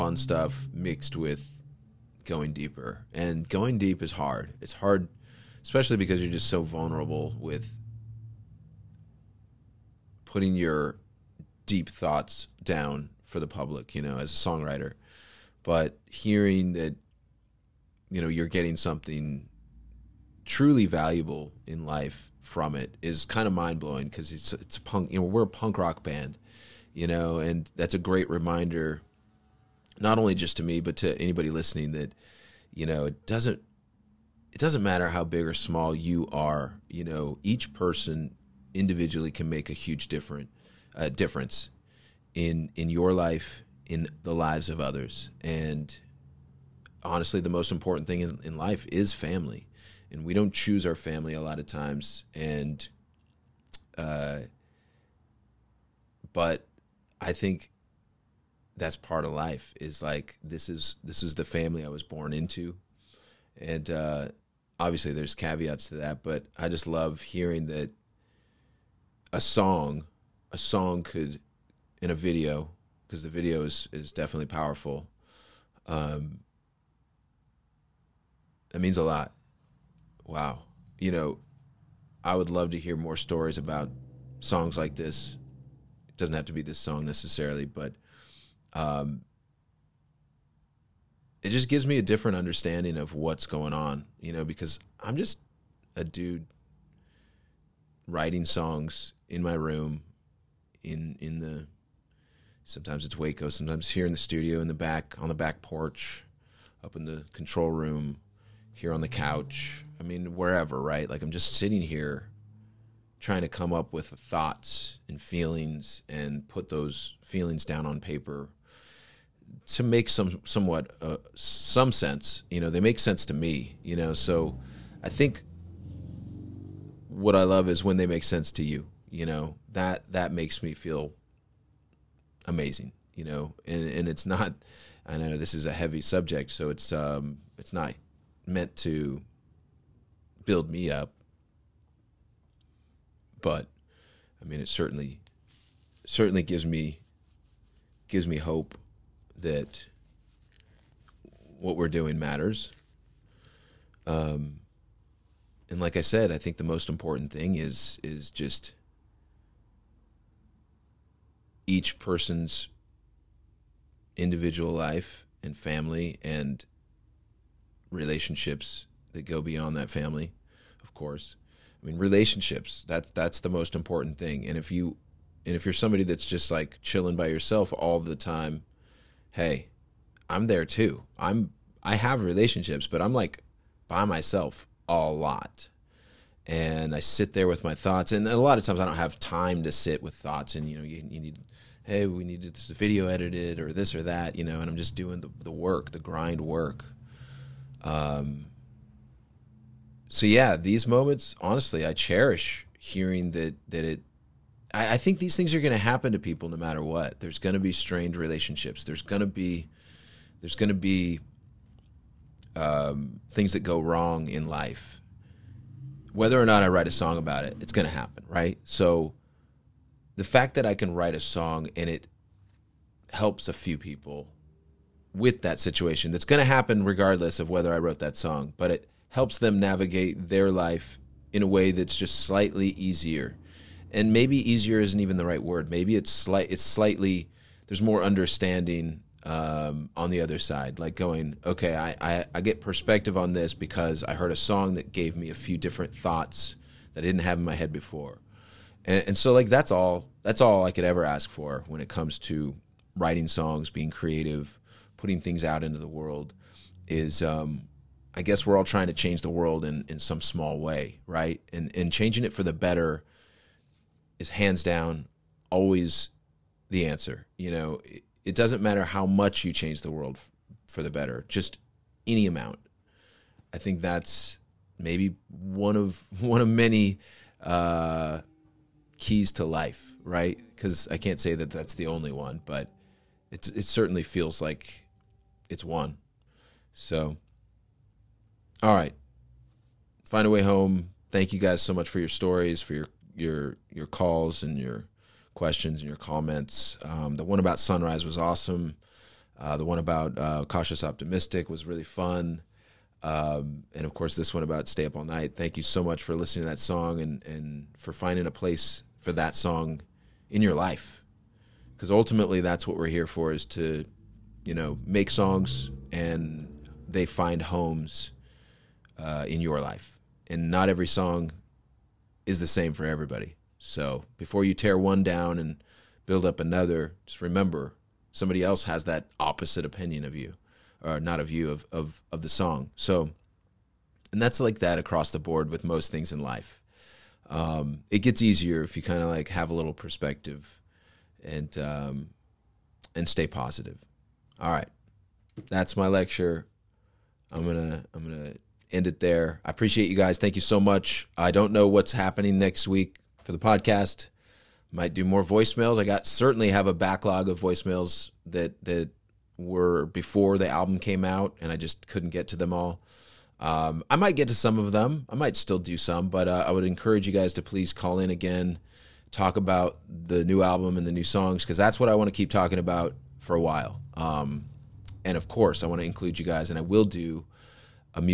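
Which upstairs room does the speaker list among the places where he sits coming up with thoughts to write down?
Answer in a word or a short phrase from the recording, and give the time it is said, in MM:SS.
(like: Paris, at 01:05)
control room, at 01:47.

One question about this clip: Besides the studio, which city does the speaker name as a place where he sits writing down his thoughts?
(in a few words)
Waco.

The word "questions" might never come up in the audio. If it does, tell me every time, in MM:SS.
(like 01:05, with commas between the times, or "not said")
04:55.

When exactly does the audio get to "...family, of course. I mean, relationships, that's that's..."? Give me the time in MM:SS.
02:49.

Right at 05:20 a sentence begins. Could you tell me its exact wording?
And not every song is the same for everybody.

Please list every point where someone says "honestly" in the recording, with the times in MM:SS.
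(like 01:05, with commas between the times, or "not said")
00:47, 03:21.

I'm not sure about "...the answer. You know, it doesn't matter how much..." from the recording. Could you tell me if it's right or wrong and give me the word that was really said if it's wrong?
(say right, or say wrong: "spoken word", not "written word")
right.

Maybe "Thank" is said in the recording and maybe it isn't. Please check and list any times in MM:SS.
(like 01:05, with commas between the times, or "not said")
04:51, 05:05, 05:50.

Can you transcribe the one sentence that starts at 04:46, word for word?
So, all right, find a way home.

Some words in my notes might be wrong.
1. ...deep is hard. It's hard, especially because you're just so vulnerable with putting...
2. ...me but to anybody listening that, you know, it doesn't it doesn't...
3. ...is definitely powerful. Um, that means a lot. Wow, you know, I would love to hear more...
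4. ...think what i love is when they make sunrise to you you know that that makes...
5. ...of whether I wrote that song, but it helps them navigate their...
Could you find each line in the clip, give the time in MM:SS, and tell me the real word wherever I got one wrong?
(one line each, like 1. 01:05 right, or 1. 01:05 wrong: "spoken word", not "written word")
1. 00:03 right
2. 00:30 right
3. 01:13 right
4. 02:05 wrong: "sense", not "sunrise"
5. 03:47 right.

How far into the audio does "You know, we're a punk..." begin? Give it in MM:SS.
00:25.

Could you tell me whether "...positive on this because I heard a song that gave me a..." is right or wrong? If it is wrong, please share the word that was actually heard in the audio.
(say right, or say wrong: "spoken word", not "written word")
wrong: "perspective", not "positive".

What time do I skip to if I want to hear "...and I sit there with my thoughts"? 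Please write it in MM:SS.
03:06.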